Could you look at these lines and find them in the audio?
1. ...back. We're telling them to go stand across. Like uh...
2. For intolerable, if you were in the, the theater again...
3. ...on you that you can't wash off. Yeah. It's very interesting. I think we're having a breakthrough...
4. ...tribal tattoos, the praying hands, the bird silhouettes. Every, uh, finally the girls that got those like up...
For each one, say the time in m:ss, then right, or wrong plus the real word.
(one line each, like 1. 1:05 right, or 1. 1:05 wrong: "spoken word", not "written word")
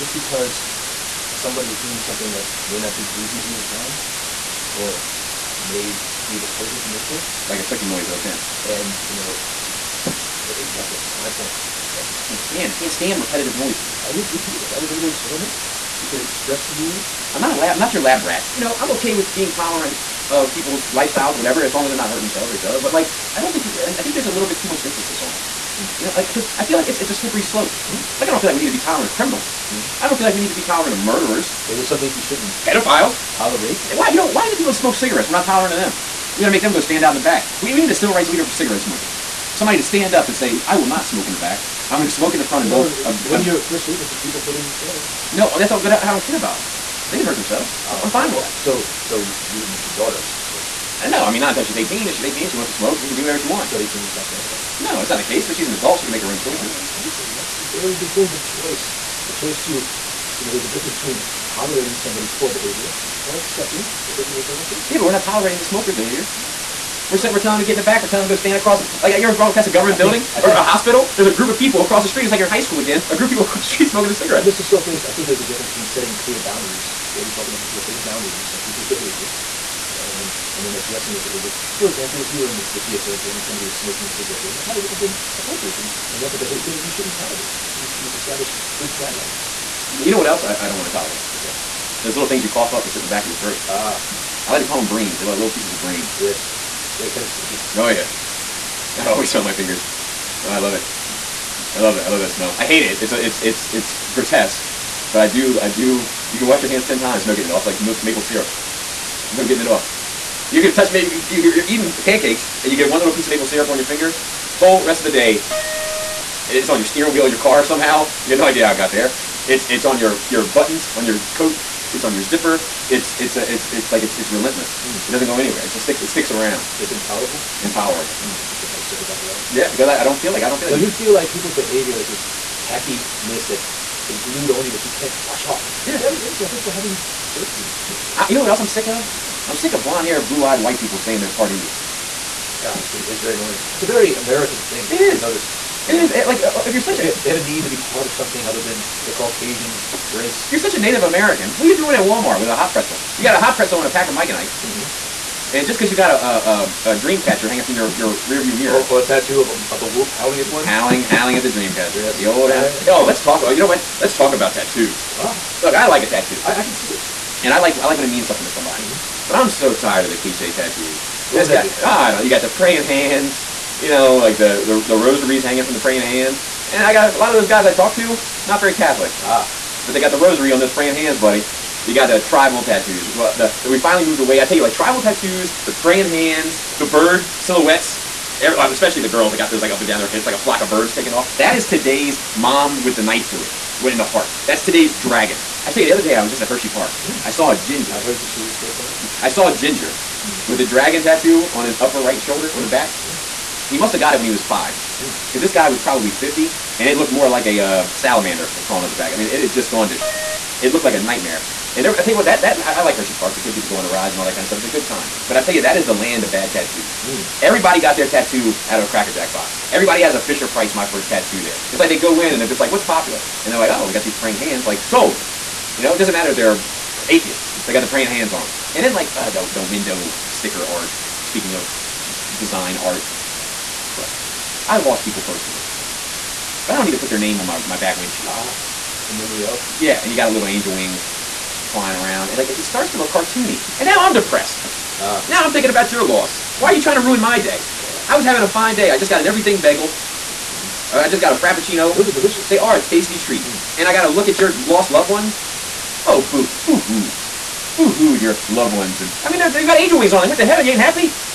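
1. 1:07 right
2. 1:21 wrong: "example", not "intolerable"
3. 2:14 right
4. 3:04 wrong: "especially", not "finally".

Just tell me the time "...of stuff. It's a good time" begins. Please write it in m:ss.
3:34.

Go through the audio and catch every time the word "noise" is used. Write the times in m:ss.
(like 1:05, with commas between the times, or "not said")
0:07, 0:13.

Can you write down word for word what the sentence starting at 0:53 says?
So at 18, you stop caring about her?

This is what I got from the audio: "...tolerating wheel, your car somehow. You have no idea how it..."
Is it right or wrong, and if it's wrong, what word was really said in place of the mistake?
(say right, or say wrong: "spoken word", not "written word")
wrong: "steering", not "tolerating".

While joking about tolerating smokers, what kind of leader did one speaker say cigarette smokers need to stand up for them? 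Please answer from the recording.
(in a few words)
civil rights leader.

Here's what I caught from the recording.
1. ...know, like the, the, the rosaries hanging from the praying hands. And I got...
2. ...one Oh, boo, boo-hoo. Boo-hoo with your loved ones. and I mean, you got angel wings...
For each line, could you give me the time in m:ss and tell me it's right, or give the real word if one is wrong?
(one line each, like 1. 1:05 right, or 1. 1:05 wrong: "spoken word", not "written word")
1. 2:53 right
2. 4:15 right.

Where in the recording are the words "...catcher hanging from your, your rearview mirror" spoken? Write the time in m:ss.
2:37.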